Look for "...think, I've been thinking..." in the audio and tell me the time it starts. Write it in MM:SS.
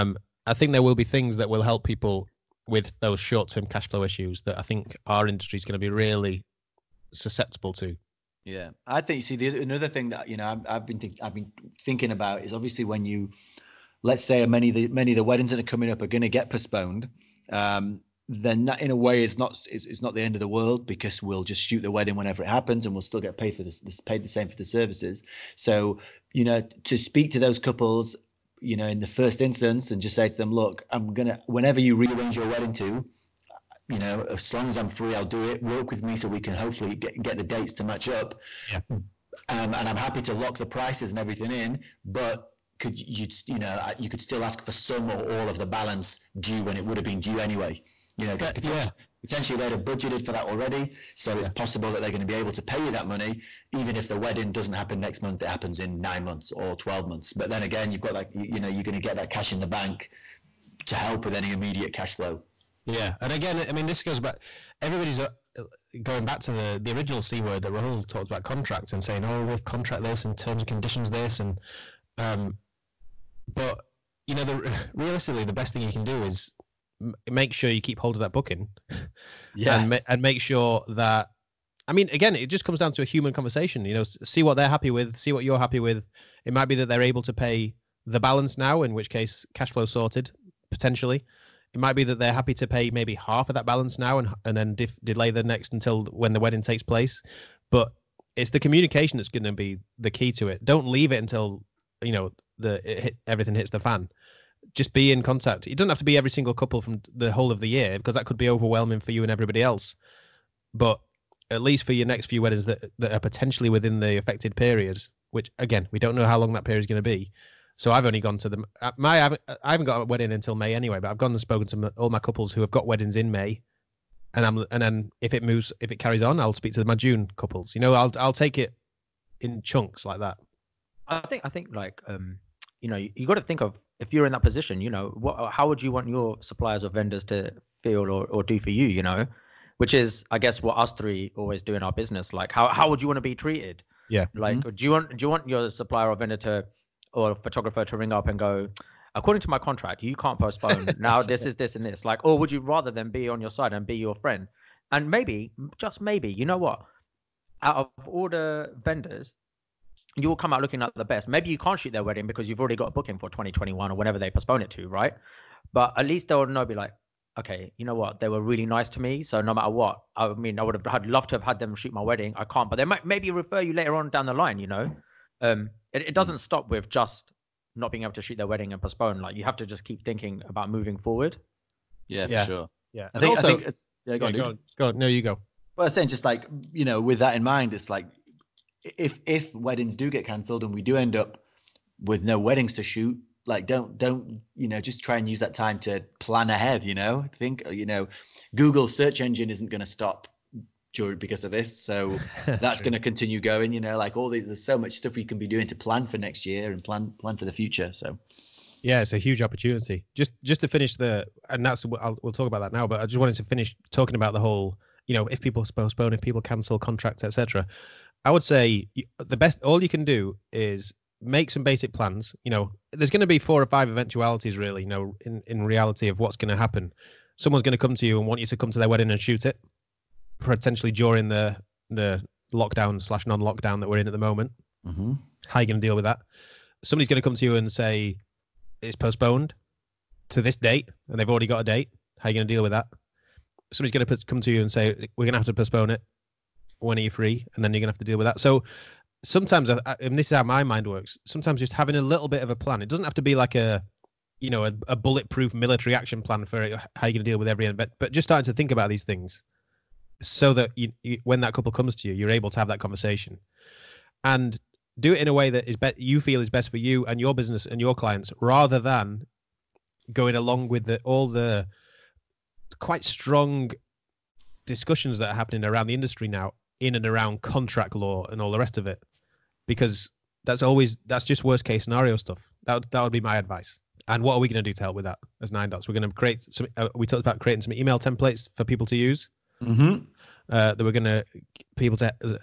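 00:10.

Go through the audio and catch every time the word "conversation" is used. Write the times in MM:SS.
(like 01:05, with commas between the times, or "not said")
01:23, 04:22.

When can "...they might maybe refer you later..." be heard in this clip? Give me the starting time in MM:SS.
02:52.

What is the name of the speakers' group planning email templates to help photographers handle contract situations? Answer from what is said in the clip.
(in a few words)
Nine Dots.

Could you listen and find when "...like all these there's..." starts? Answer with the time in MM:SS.
03:23.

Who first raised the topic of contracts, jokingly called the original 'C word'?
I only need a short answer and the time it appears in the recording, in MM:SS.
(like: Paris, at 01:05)
Rahul, at 01:07.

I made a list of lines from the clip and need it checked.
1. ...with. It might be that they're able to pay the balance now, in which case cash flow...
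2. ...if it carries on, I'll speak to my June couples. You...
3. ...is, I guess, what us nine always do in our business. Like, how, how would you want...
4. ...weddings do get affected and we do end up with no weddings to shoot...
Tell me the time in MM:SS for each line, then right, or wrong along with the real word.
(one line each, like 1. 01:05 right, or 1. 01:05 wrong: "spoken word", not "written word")
1. 01:25 right
2. 02:05 right
3. 02:19 wrong: "three", not "nine"
4. 03:09 wrong: "cancelled", not "affected".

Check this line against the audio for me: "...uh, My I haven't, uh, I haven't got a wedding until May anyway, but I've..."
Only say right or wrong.
right.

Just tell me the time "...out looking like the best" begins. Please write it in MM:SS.
02:40.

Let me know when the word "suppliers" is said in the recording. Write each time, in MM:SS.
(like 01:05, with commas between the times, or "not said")
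02:16, 02:25.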